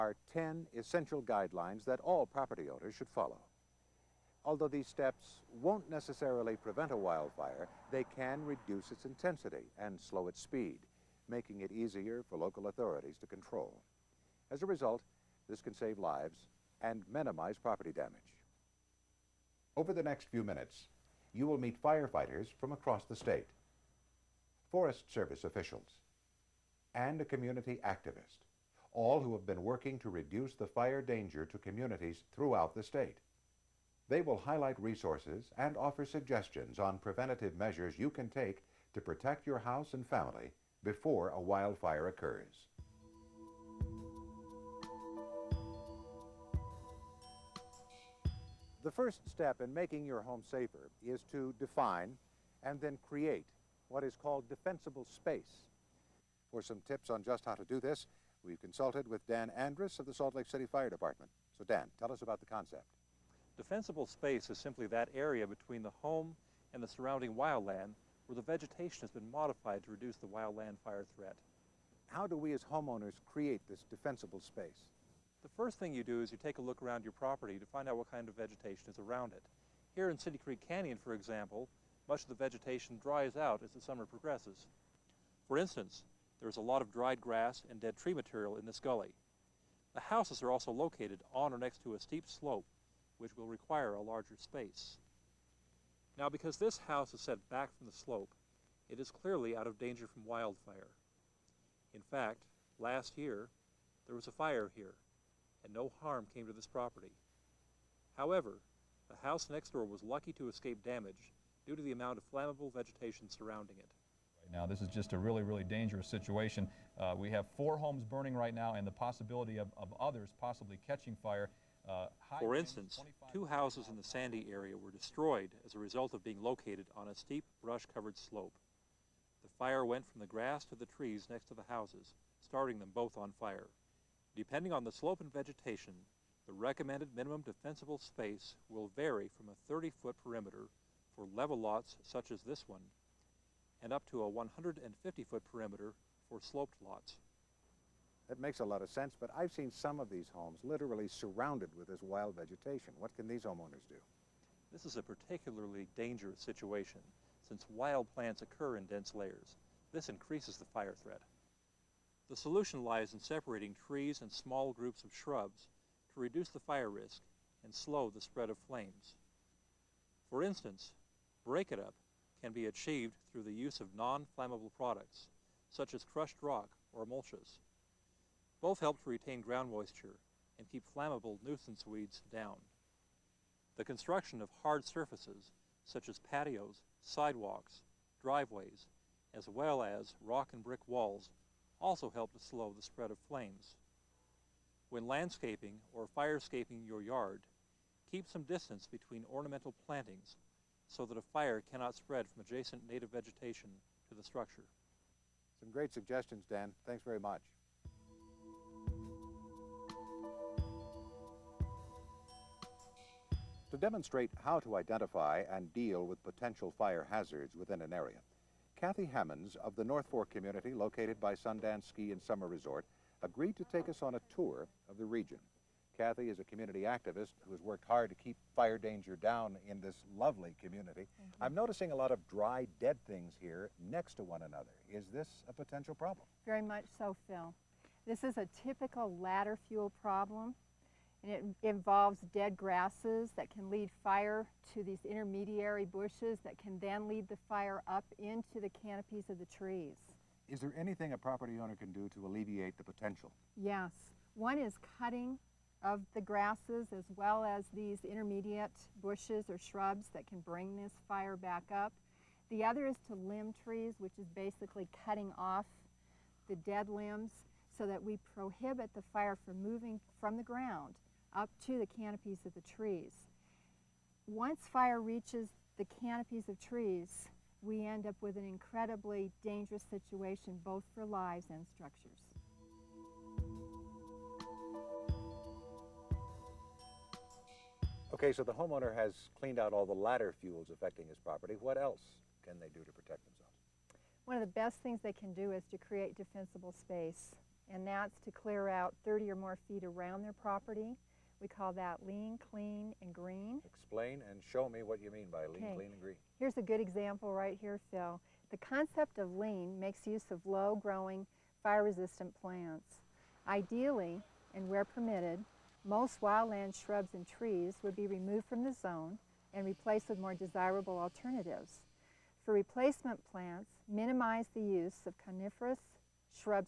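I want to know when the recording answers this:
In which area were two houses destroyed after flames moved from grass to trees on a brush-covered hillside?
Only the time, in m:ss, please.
2:04.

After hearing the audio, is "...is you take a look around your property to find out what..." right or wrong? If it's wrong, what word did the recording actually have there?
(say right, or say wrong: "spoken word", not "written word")
right.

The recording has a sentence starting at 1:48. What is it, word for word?
However, the house next door was lucky to escape damage due to the amount of flammable vegetation surrounding it.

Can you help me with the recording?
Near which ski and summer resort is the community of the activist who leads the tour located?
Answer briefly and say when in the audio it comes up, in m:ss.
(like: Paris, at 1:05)
Sundance, at 3:41.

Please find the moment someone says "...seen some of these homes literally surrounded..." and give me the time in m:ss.
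2:29.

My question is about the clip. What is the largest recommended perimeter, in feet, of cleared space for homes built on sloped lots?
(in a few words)
150 feet.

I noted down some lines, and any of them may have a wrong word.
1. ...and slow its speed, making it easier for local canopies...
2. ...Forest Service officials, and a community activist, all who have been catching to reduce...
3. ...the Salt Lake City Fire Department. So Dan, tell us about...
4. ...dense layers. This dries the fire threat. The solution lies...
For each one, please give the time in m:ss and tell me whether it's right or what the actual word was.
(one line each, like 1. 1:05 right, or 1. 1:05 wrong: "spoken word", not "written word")
1. 0:09 wrong: "authorities", not "canopies"
2. 0:24 wrong: "working", not "catching"
3. 1:00 right
4. 2:38 wrong: "increases", not "dries".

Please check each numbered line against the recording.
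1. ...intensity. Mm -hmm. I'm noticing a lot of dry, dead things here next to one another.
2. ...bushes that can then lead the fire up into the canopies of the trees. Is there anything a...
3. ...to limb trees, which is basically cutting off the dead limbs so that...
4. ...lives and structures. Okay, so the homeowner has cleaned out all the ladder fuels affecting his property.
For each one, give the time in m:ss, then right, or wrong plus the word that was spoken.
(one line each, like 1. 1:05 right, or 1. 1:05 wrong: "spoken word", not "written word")
1. 3:50 wrong: "community", not "intensity"
2. 4:05 right
3. 4:23 right
4. 4:41 right.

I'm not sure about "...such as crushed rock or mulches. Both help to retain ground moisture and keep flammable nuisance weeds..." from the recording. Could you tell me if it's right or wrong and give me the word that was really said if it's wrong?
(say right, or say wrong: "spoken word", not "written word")
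right.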